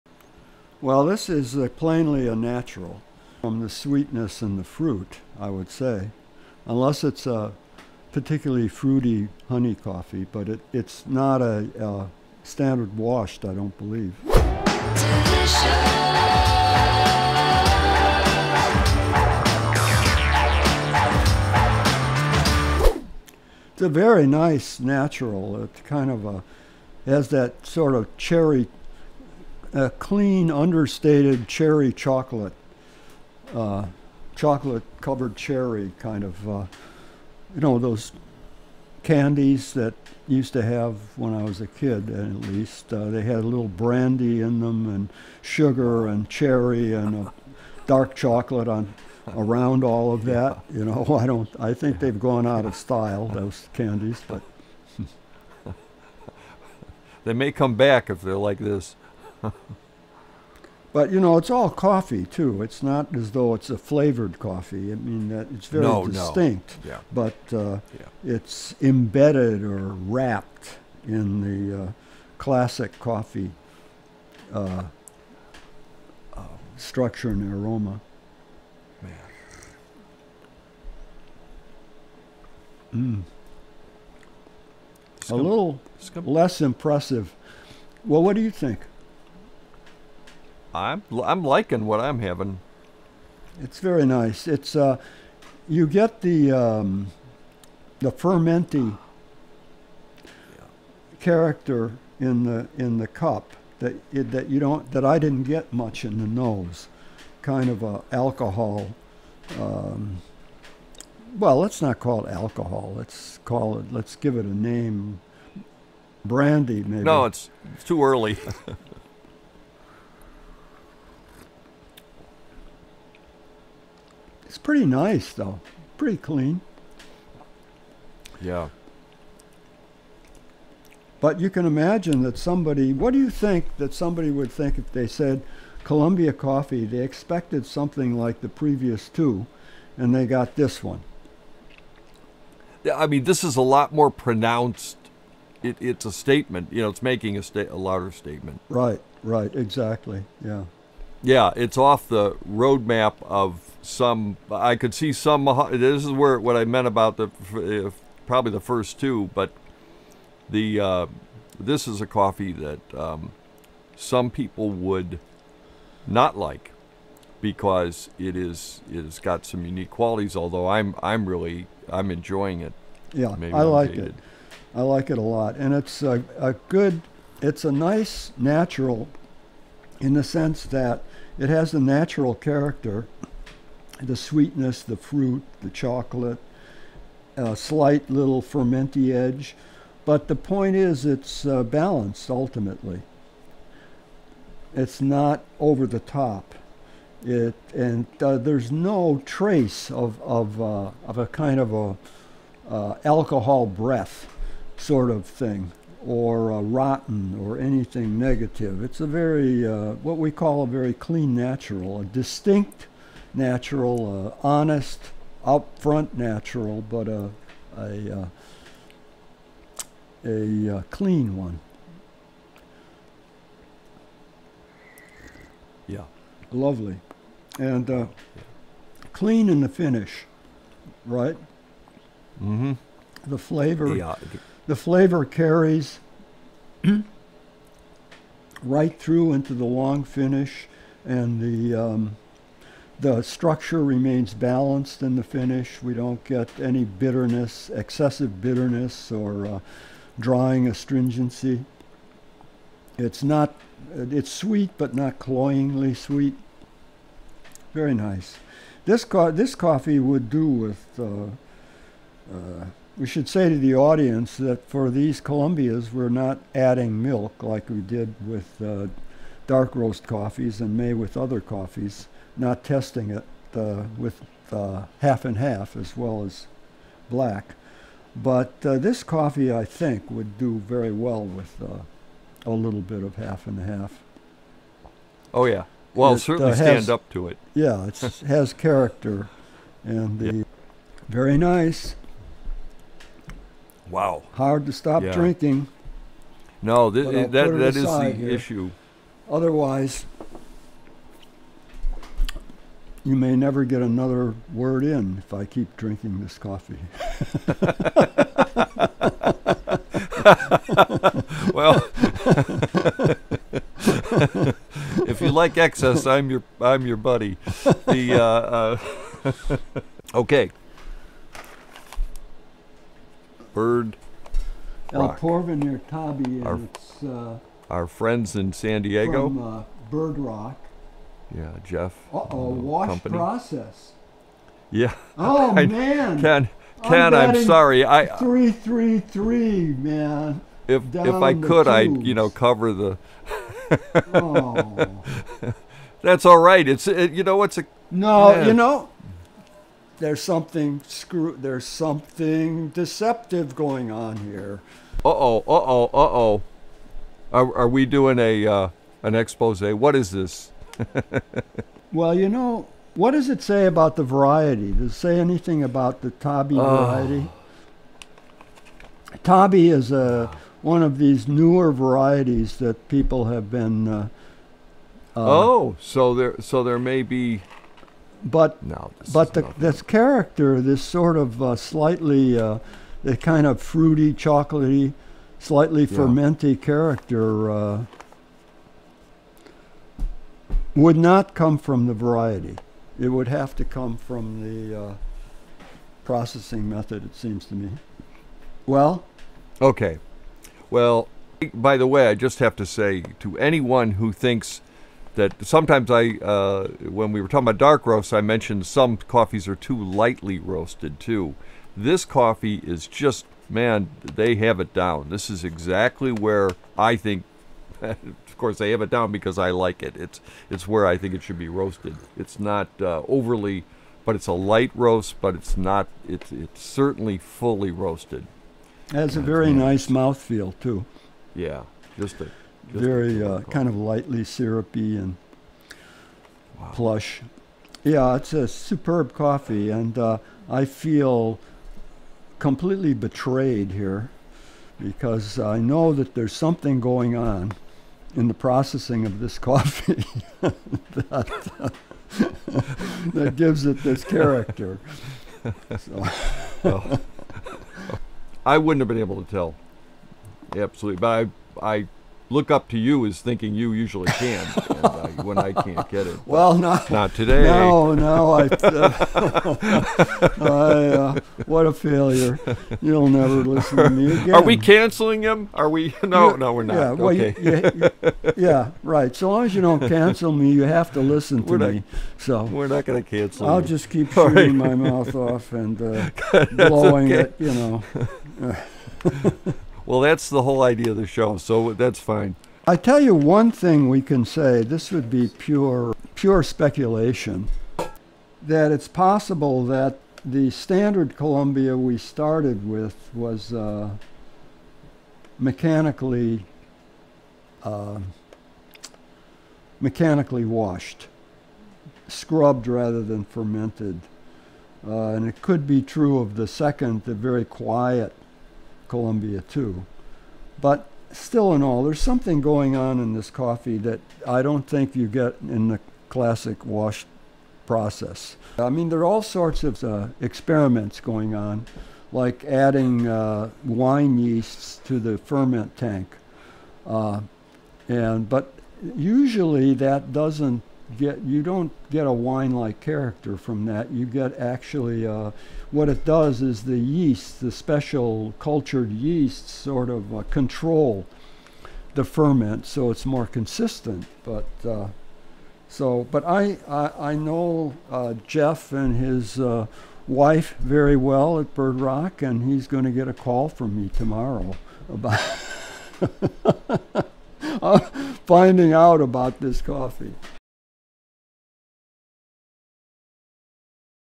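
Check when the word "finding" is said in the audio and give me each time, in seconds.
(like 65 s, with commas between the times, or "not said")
568 s.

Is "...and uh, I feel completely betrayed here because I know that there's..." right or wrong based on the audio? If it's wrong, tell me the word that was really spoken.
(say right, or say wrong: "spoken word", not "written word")
right.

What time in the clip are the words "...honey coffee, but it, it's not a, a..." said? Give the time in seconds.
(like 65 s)
9 s.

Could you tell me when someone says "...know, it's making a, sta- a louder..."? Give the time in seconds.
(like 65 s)
146 s.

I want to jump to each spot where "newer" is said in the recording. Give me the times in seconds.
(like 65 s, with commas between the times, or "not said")
371 s.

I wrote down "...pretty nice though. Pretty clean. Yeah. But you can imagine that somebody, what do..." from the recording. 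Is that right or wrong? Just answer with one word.
right.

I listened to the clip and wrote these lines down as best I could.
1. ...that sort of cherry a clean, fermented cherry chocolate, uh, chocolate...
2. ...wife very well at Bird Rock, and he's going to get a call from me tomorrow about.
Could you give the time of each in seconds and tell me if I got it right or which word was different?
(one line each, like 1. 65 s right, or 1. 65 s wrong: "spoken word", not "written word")
1. 27 s wrong: "understated", not "fermented"
2. 560 s right.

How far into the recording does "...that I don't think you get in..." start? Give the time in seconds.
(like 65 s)
523 s.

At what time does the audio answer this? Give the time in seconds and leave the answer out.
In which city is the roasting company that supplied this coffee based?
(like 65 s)
328 s.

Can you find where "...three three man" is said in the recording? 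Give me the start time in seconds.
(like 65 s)
338 s.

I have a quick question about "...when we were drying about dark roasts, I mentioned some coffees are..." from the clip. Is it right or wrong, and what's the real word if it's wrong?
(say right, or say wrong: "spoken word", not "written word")
wrong: "talking", not "drying".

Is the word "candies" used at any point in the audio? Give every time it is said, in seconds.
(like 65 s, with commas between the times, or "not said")
39 s, 53 s.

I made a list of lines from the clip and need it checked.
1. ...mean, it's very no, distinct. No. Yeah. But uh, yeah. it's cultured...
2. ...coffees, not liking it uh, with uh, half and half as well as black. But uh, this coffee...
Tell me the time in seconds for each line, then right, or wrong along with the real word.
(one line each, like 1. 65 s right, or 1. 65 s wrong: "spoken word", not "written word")
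1. 64 s wrong: "embedded", not "cultured"
2. 271 s wrong: "testing", not "liking".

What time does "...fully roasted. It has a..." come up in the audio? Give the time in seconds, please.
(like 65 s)
427 s.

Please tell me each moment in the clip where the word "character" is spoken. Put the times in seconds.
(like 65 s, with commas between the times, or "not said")
101 s, 182 s, 288 s, 379 s, 386 s, 454 s, 542 s.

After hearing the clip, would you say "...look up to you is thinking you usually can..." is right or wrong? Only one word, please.
right.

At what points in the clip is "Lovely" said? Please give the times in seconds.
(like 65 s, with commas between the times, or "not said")
226 s.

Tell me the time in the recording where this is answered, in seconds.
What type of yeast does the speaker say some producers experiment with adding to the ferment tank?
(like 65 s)
533 s.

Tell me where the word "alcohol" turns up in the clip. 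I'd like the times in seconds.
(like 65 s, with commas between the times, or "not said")
108 s, 112 s, 203 s.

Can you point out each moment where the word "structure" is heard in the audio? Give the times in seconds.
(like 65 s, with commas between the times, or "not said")
76 s, 243 s.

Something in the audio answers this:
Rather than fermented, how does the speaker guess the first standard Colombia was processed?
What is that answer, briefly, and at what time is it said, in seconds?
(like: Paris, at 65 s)
Mechanically washed, at 509 s.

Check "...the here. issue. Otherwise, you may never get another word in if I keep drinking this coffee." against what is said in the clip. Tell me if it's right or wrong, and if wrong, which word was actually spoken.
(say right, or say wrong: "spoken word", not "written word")
right.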